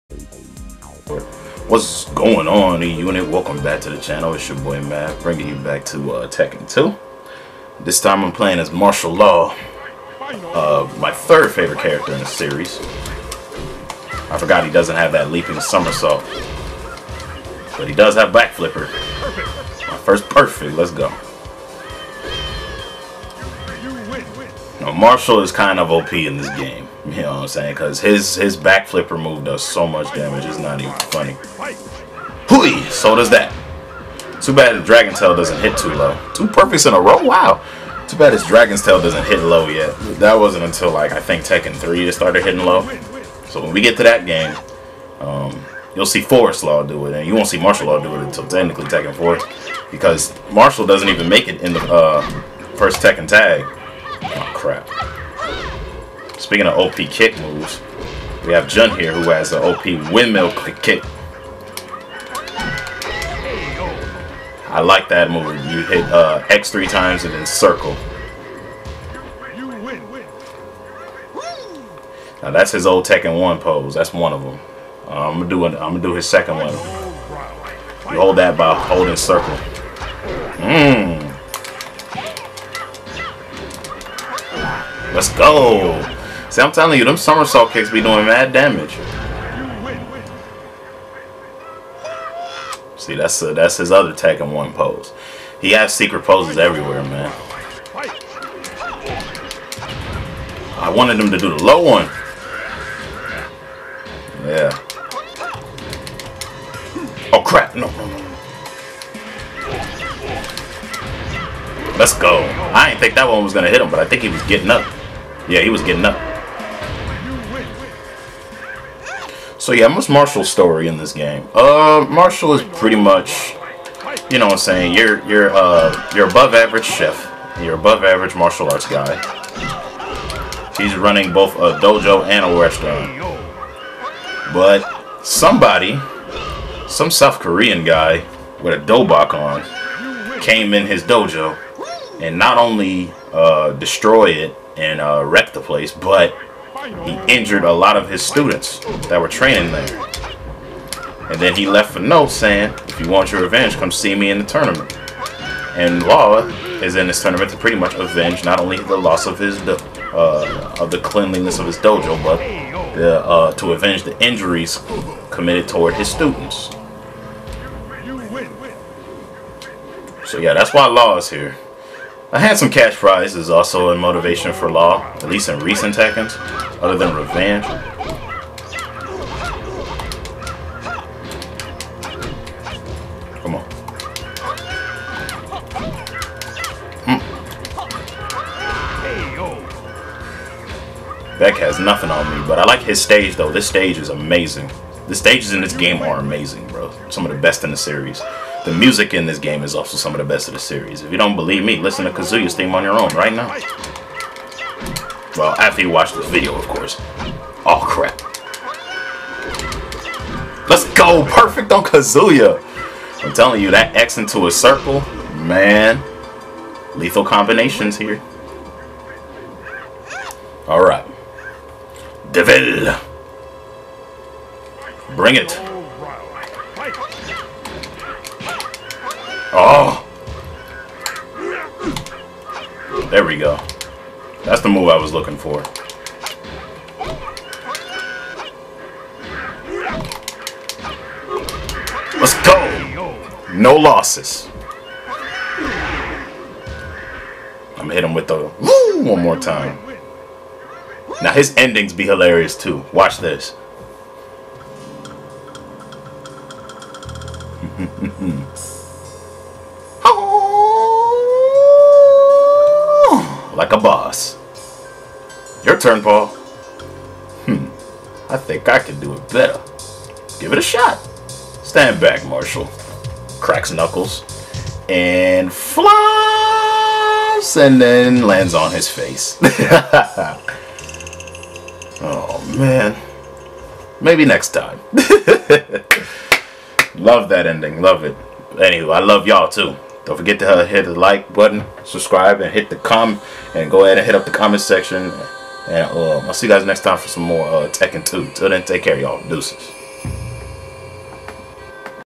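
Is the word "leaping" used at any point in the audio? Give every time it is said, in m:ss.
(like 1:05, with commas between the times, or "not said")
0:15.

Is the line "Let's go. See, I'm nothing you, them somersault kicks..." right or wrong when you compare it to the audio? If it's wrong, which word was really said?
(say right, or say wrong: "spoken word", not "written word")
wrong: "telling", not "nothing".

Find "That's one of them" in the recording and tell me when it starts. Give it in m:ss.
1:13.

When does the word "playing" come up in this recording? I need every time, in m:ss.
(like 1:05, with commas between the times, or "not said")
0:08.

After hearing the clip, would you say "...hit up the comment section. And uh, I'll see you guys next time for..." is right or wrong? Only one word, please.
right.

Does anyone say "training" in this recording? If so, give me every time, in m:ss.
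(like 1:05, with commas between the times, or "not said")
2:29.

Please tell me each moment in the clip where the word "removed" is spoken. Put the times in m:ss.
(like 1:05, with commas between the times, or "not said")
0:29.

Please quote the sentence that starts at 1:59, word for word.
So yeah, what's Marshall's story in this game?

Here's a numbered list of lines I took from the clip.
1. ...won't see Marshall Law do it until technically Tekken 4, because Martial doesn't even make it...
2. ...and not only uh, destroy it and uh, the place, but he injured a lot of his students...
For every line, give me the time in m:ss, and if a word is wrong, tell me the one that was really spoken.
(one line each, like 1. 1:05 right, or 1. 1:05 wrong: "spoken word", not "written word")
1. 0:47 right
2. 2:22 right.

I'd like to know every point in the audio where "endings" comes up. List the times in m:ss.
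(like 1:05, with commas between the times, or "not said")
4:11, 4:47.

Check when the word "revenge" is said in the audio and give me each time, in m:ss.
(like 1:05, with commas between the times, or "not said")
2:33, 2:57.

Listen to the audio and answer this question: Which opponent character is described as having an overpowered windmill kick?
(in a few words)
Jun.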